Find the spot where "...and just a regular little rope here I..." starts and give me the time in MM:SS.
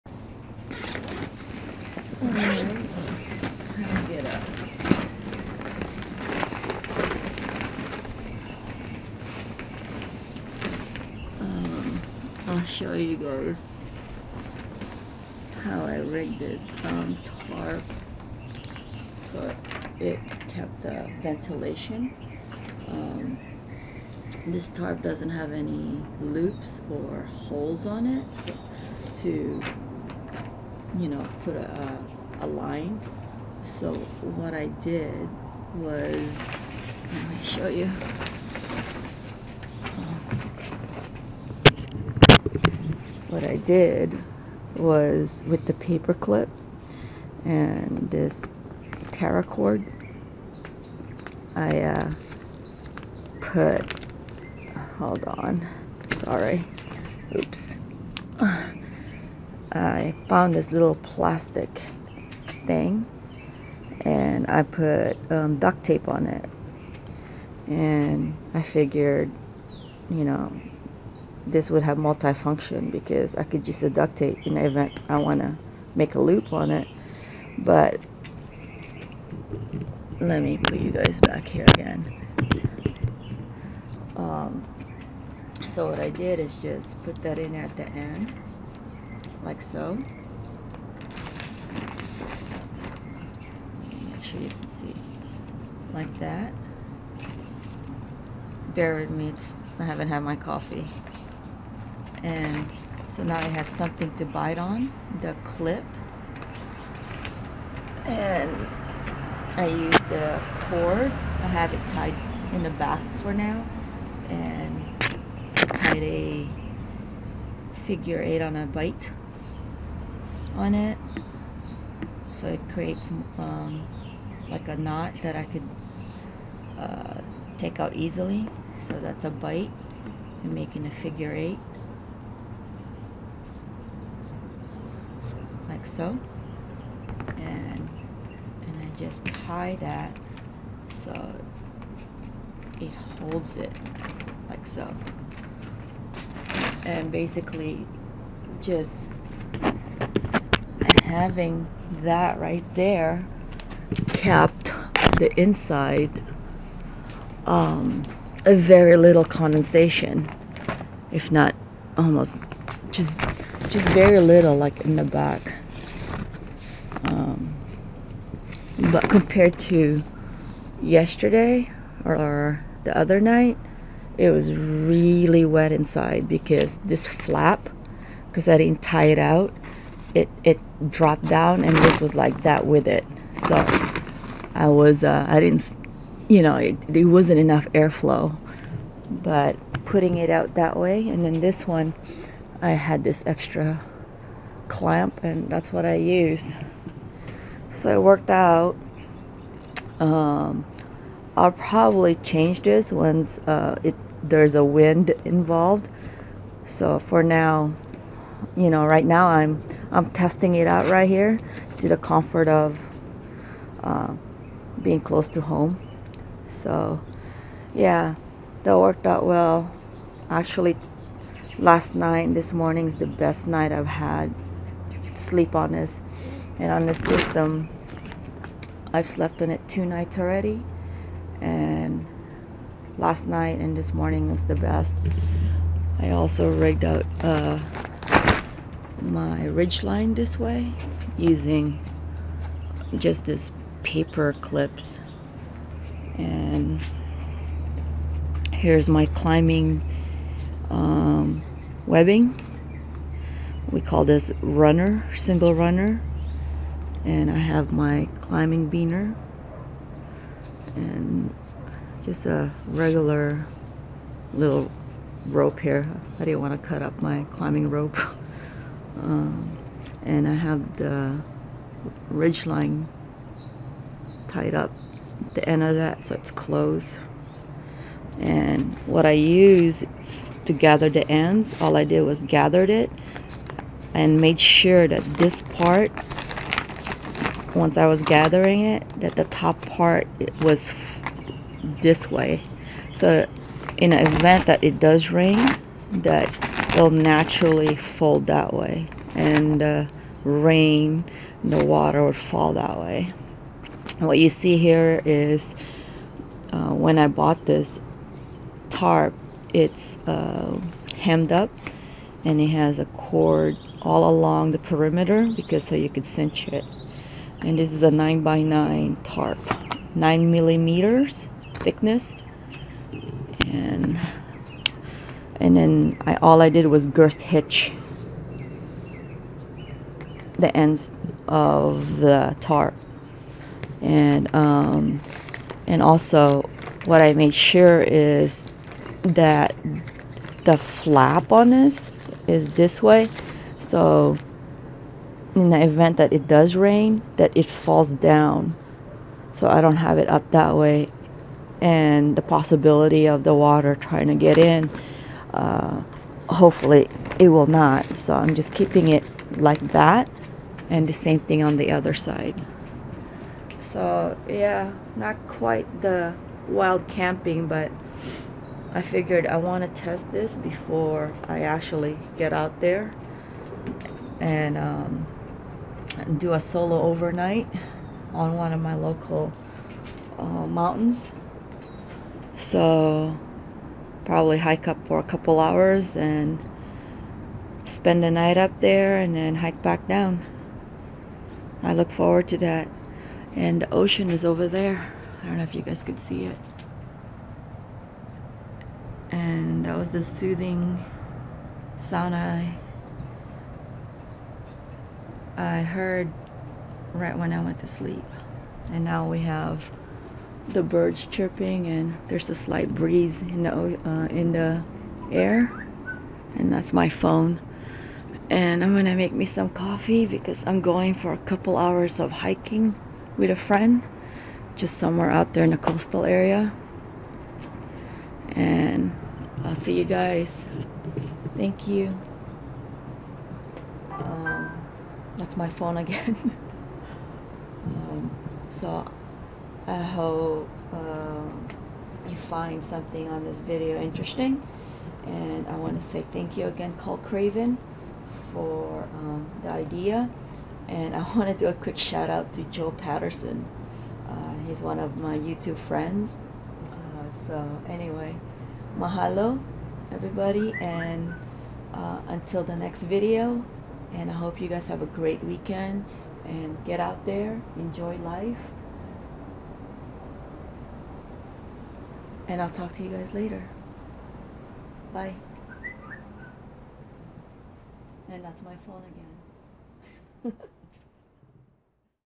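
04:20.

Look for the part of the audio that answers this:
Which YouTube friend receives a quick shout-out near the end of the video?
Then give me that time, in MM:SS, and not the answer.
07:32.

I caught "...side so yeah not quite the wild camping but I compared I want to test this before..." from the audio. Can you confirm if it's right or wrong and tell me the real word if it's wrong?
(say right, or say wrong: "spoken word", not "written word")
wrong: "figured", not "compared".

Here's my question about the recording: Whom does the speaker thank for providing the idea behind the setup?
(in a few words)
Cole Craven.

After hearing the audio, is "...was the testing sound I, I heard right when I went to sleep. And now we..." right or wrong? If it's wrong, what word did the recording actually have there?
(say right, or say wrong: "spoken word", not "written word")
wrong: "soothing", not "testing".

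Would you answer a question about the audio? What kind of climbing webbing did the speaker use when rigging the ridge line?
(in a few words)
single runner.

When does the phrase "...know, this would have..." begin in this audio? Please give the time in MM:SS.
01:10.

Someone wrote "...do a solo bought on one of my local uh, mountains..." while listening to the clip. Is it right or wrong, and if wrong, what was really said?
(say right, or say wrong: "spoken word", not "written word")
wrong: "overnight", not "bought".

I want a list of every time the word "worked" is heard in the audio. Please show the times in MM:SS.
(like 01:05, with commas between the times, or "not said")
03:18, 03:38.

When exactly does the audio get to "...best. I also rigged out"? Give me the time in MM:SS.
03:54.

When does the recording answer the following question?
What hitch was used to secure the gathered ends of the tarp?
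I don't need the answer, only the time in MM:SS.
05:26.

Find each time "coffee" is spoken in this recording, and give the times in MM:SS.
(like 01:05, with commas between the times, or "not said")
01:40, 06:59.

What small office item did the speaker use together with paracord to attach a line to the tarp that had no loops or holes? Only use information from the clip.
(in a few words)
paper clip.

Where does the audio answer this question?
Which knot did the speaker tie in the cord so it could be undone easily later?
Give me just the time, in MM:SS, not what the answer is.
01:57.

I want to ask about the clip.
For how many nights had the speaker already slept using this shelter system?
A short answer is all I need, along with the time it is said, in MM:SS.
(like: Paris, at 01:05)
2, at 03:49.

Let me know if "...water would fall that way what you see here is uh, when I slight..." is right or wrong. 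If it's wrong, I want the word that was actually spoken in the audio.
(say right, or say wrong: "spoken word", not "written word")
wrong: "bought", not "slight".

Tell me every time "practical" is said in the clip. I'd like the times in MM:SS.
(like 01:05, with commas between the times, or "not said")
not said.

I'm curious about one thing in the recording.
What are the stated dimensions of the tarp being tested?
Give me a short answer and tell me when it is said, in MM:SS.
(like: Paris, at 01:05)
9 by 9, at 05:17.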